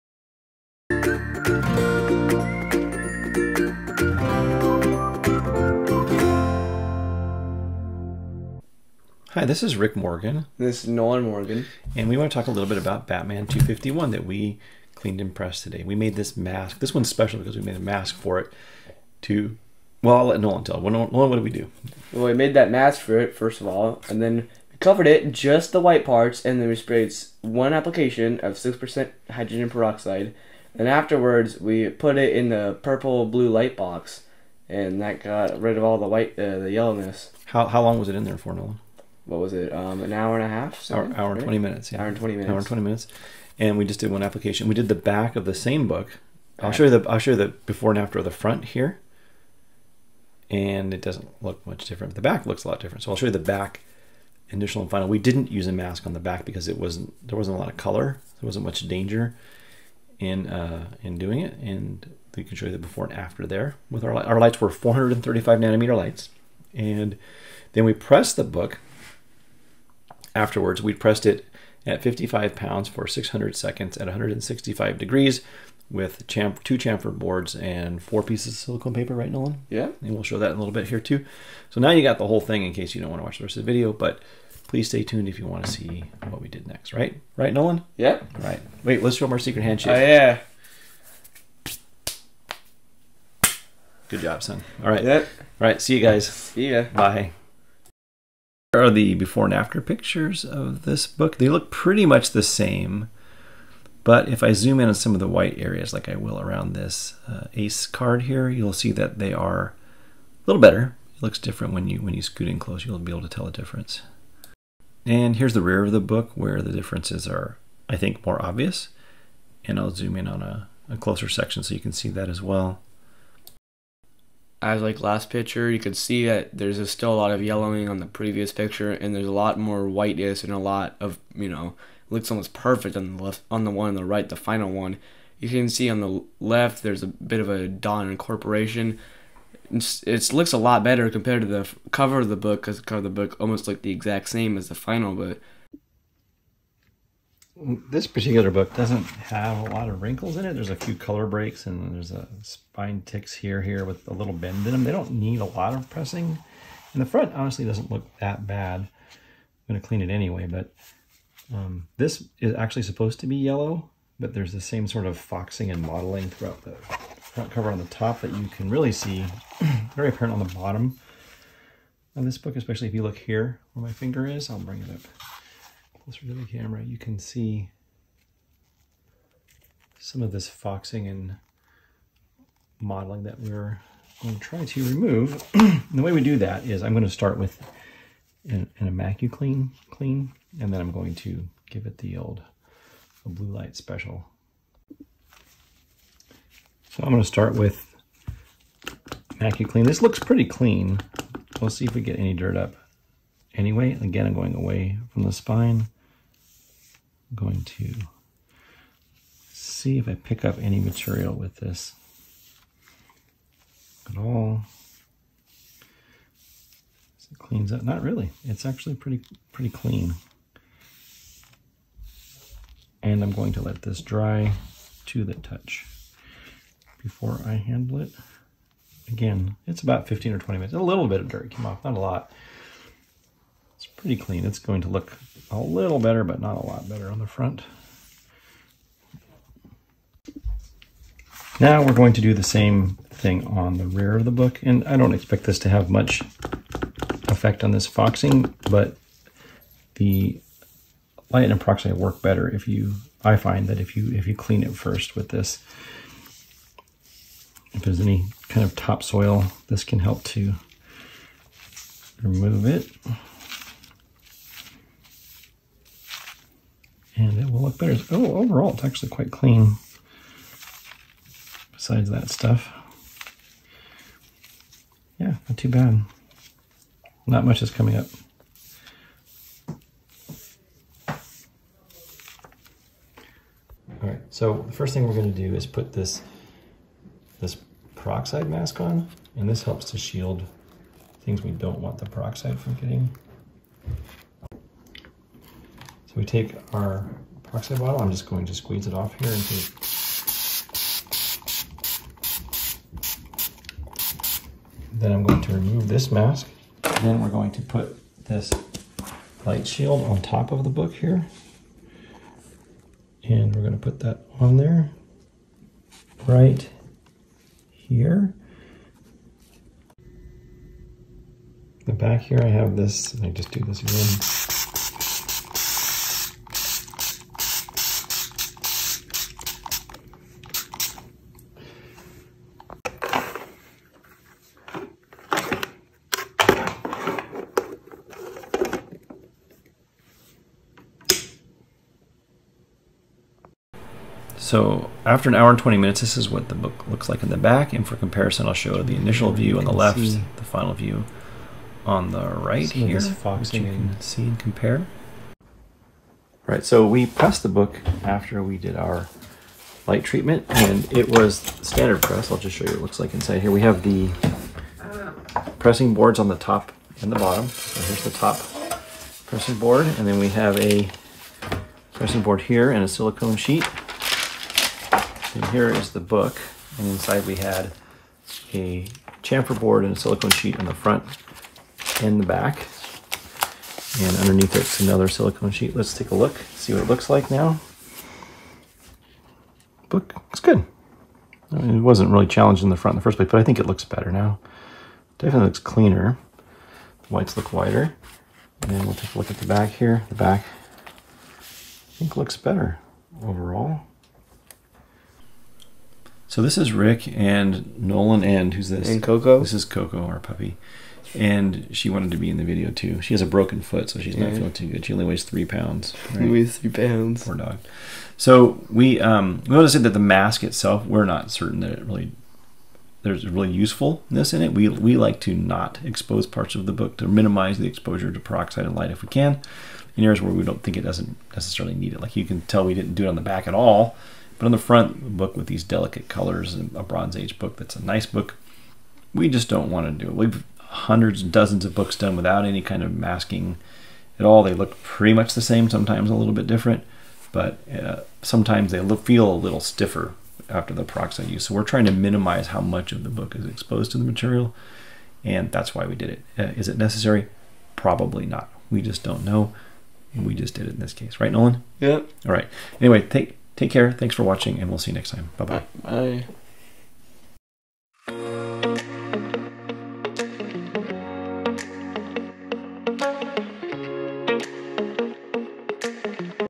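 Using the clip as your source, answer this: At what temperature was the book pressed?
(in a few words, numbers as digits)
165 degrees.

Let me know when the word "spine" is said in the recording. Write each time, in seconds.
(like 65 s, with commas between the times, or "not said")
152 s, 205 s.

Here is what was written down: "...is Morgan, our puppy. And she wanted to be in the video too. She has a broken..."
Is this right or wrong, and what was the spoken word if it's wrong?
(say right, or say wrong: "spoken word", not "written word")
wrong: "Coco", not "Morgan".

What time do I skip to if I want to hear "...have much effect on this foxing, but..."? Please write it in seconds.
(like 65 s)
245 s.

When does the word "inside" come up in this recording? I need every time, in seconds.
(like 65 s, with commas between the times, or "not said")
363 s, 376 s.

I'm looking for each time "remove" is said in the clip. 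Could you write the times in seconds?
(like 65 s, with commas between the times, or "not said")
184 s, 262 s, 305 s.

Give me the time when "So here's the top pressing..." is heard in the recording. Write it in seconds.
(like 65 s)
367 s.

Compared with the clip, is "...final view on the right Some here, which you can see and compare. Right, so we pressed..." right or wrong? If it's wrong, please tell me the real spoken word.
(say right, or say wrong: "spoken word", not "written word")
right.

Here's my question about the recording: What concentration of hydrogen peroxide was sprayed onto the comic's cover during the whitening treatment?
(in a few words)
6%.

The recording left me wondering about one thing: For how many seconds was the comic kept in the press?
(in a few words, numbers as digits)
600.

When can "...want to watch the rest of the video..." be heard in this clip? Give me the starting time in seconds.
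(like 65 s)
83 s.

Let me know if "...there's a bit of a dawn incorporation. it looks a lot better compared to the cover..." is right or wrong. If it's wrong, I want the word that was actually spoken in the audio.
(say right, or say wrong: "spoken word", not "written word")
right.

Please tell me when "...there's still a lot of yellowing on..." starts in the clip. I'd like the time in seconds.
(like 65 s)
126 s.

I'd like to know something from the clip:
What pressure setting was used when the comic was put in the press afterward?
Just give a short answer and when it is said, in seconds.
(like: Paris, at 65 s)
55 pounds, at 72 s.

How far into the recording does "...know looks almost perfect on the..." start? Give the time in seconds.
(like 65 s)
131 s.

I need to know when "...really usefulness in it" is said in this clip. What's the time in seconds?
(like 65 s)
423 s.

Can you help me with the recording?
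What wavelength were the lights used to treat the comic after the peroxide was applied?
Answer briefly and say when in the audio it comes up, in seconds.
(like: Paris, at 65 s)
435 nanometers, at 64 s.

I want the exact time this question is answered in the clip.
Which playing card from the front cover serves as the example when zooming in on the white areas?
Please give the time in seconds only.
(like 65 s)
107 s.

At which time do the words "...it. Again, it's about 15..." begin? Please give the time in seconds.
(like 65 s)
228 s.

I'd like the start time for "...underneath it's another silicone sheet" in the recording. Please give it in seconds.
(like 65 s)
384 s.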